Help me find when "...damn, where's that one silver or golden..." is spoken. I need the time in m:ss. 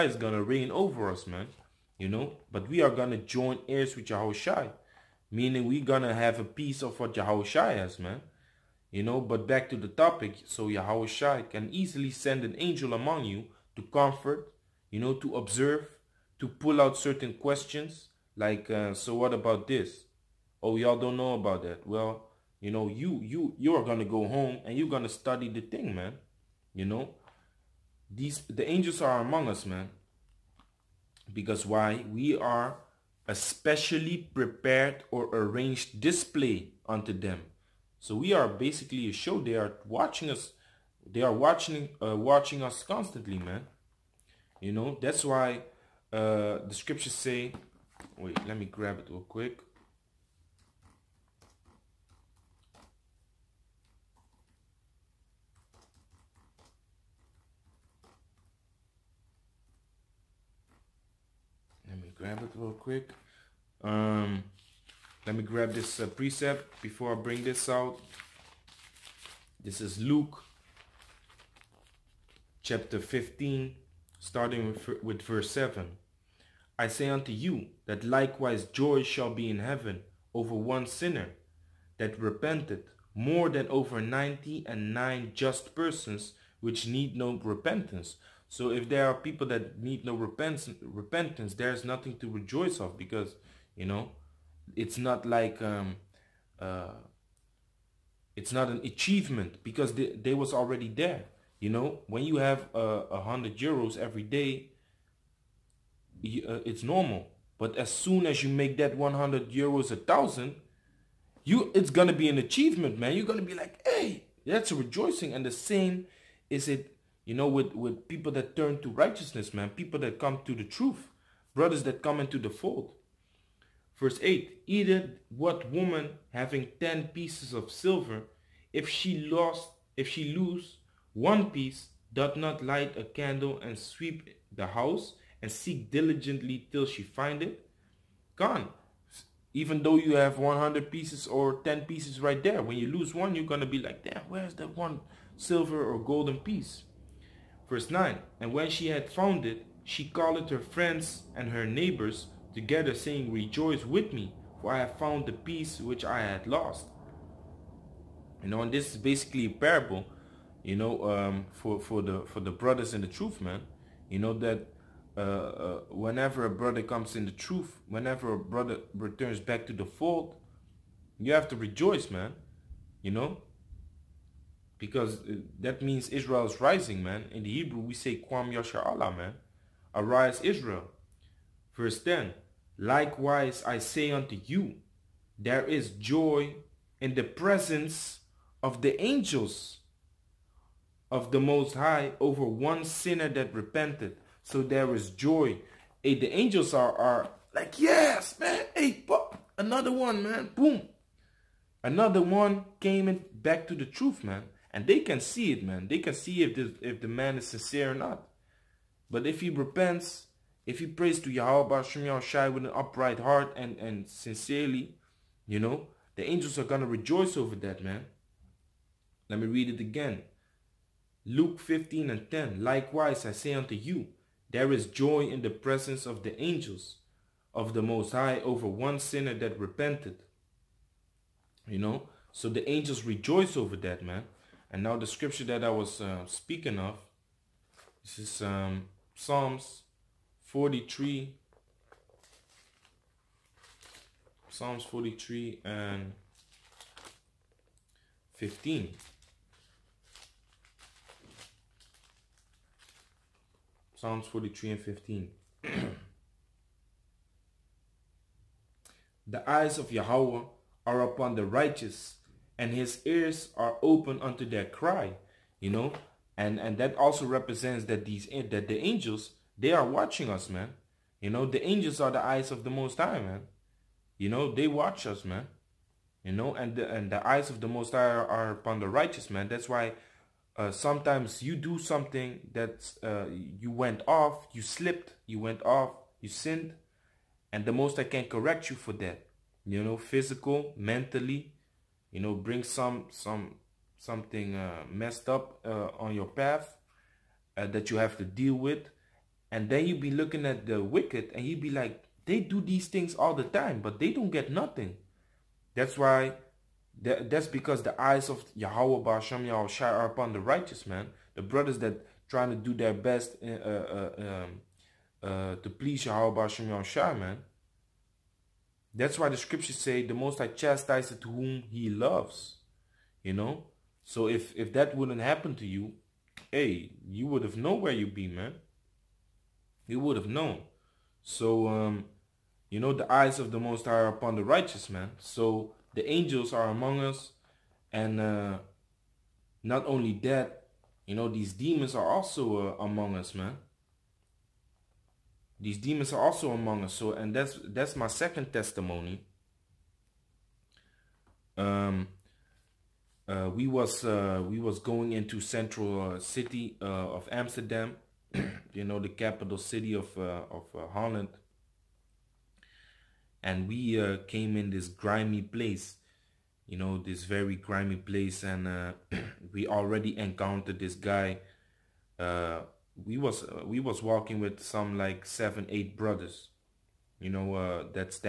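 2:24.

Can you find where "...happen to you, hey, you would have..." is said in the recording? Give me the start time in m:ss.
5:25.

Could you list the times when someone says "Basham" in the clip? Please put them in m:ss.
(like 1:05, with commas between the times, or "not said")
5:09, 5:16.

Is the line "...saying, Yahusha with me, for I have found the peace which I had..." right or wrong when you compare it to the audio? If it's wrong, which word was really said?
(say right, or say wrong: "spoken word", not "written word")
wrong: "Rejoice", not "Yahusha".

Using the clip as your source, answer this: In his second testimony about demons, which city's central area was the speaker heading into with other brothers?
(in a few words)
Amsterdam.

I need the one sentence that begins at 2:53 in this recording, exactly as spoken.
You know, because uh, that means Israel is rising, man.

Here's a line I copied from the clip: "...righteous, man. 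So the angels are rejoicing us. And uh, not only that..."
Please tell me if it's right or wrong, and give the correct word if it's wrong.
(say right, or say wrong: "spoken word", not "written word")
wrong: "among", not "rejoicing".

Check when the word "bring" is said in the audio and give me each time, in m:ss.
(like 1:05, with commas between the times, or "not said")
1:07, 4:52.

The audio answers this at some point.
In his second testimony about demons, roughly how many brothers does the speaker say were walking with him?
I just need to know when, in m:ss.
6:15.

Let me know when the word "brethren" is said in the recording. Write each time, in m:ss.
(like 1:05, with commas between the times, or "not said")
not said.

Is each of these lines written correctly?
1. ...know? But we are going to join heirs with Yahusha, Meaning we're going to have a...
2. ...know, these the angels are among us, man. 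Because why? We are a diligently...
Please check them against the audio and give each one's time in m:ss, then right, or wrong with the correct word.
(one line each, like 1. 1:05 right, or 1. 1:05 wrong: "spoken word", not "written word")
1. 0:02 right
2. 0:26 wrong: "specially", not "diligently".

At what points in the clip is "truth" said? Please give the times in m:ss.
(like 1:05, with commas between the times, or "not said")
2:00, 2:43, 2:47, 3:23.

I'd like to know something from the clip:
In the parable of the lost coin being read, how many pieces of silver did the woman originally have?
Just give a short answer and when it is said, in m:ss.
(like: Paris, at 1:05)
10, at 2:06.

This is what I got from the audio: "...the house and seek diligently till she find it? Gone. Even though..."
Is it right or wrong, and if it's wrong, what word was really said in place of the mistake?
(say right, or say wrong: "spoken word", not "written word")
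right.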